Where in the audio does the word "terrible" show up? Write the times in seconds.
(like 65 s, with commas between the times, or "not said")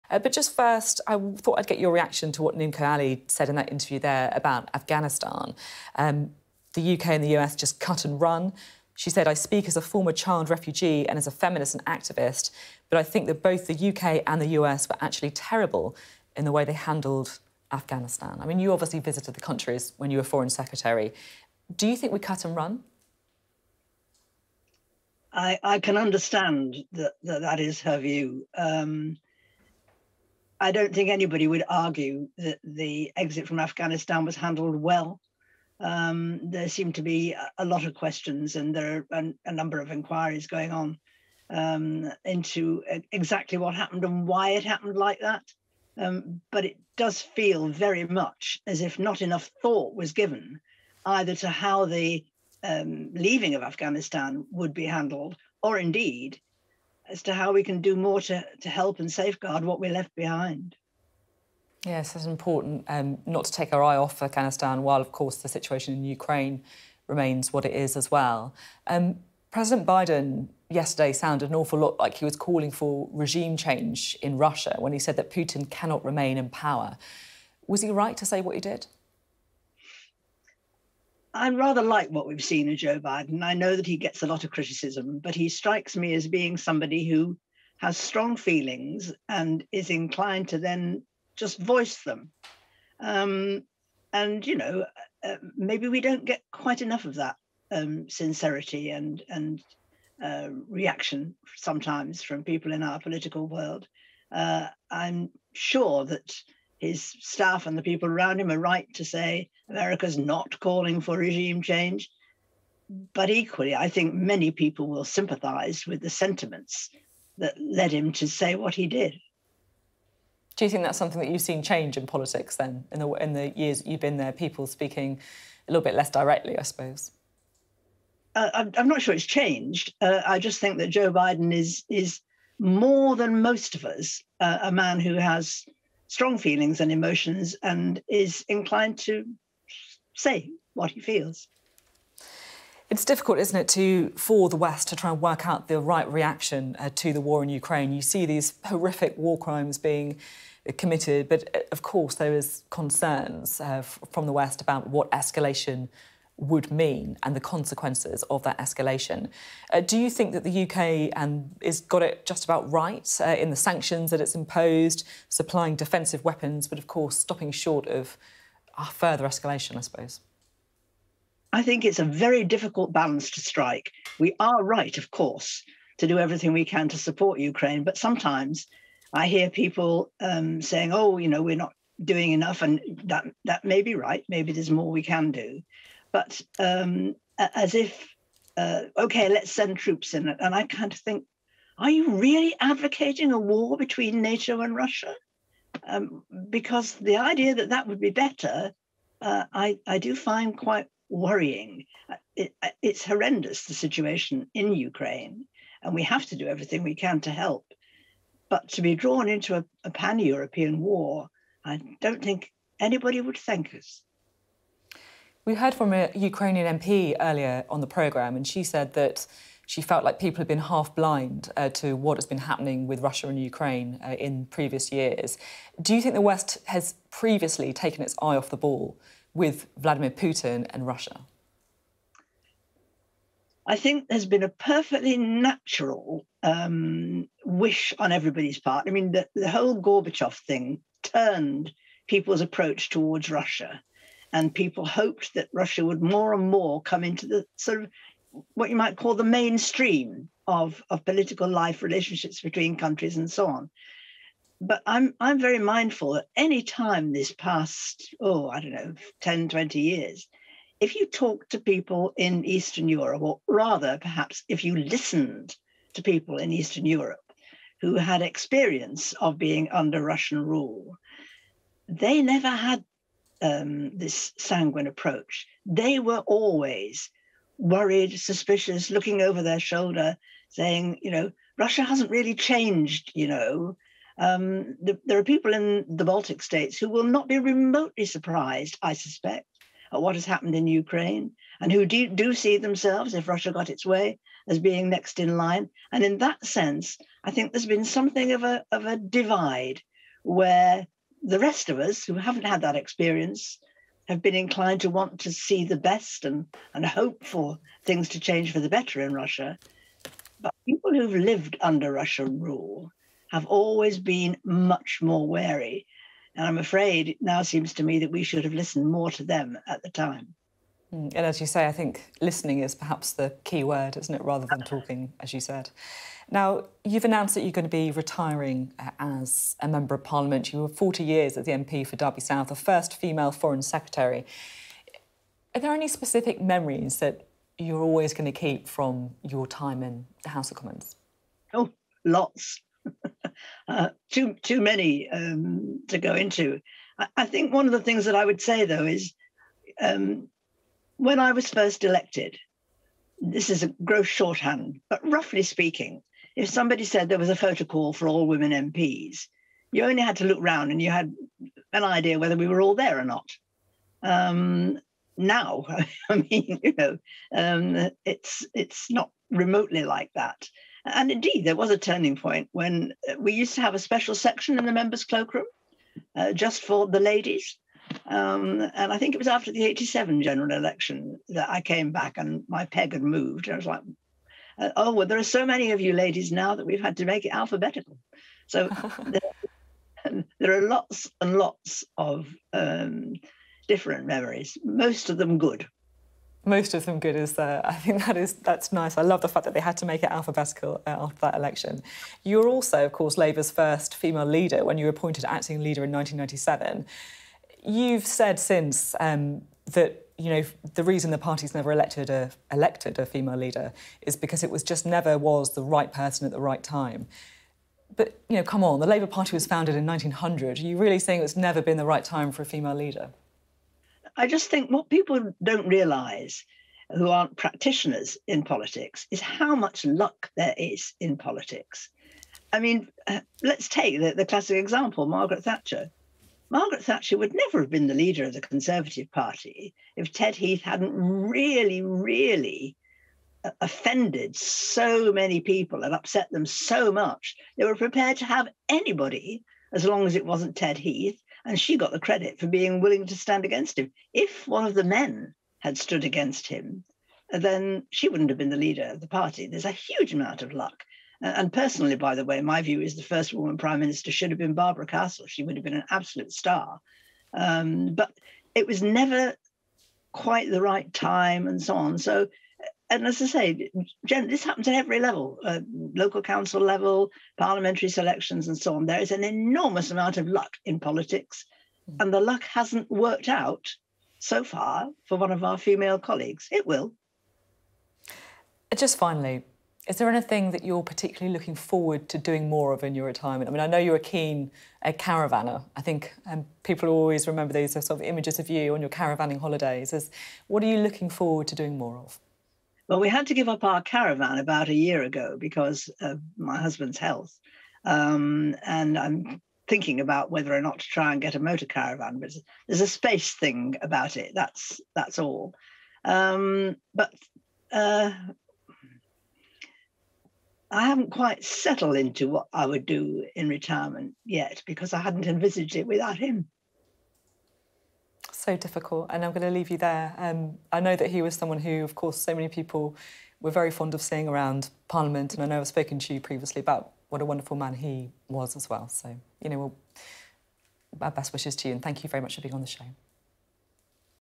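15 s.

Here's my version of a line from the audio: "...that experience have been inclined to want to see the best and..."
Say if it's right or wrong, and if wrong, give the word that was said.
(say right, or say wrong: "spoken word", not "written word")
right.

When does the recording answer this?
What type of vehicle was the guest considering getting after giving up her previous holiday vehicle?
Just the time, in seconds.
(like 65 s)
511 s.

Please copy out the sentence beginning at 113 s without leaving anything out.
But equally, I think many people will sympathize with the sentiments that led him to say what he did.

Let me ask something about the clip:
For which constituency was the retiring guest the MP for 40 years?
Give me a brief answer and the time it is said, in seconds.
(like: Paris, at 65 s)
Derby South, at 331 s.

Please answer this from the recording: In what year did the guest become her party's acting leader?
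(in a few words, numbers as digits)
1997.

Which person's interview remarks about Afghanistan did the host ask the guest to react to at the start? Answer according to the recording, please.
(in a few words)
Nimco Ali.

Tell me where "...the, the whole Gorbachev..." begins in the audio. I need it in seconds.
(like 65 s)
239 s.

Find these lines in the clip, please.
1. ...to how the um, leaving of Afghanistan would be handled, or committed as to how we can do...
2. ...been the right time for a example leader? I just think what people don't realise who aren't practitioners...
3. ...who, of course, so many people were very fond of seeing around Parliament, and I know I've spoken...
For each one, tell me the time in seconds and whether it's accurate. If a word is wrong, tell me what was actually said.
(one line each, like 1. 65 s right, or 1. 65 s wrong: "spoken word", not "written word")
1. 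51 s wrong: "indeed", not "committed"
2. 421 s wrong: "female", not "example"
3. 531 s right.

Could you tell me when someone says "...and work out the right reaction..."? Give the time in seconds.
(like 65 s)
145 s.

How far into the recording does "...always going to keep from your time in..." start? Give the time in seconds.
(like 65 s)
337 s.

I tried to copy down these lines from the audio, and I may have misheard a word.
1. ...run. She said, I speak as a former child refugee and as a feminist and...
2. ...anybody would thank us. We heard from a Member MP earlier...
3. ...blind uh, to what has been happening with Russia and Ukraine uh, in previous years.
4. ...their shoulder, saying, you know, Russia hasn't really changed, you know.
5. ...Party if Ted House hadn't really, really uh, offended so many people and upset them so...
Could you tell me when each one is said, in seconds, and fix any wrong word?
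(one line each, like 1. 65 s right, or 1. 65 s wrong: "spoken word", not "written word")
1. 8 s right
2. 212 s wrong: "Ukrainian", not "Member"
3. 220 s right
4. 279 s right
5. 439 s wrong: "Heath", not "House".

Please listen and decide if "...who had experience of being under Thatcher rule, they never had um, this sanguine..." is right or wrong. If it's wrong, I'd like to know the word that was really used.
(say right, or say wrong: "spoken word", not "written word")
wrong: "Russian", not "Thatcher".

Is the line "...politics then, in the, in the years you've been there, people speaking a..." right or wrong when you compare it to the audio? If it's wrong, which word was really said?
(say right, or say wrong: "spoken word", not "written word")
right.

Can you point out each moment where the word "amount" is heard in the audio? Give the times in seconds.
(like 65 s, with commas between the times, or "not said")
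460 s, 479 s.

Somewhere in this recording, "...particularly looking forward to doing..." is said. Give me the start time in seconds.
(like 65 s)
490 s.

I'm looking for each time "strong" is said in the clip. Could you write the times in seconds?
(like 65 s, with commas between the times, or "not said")
87 s, 136 s.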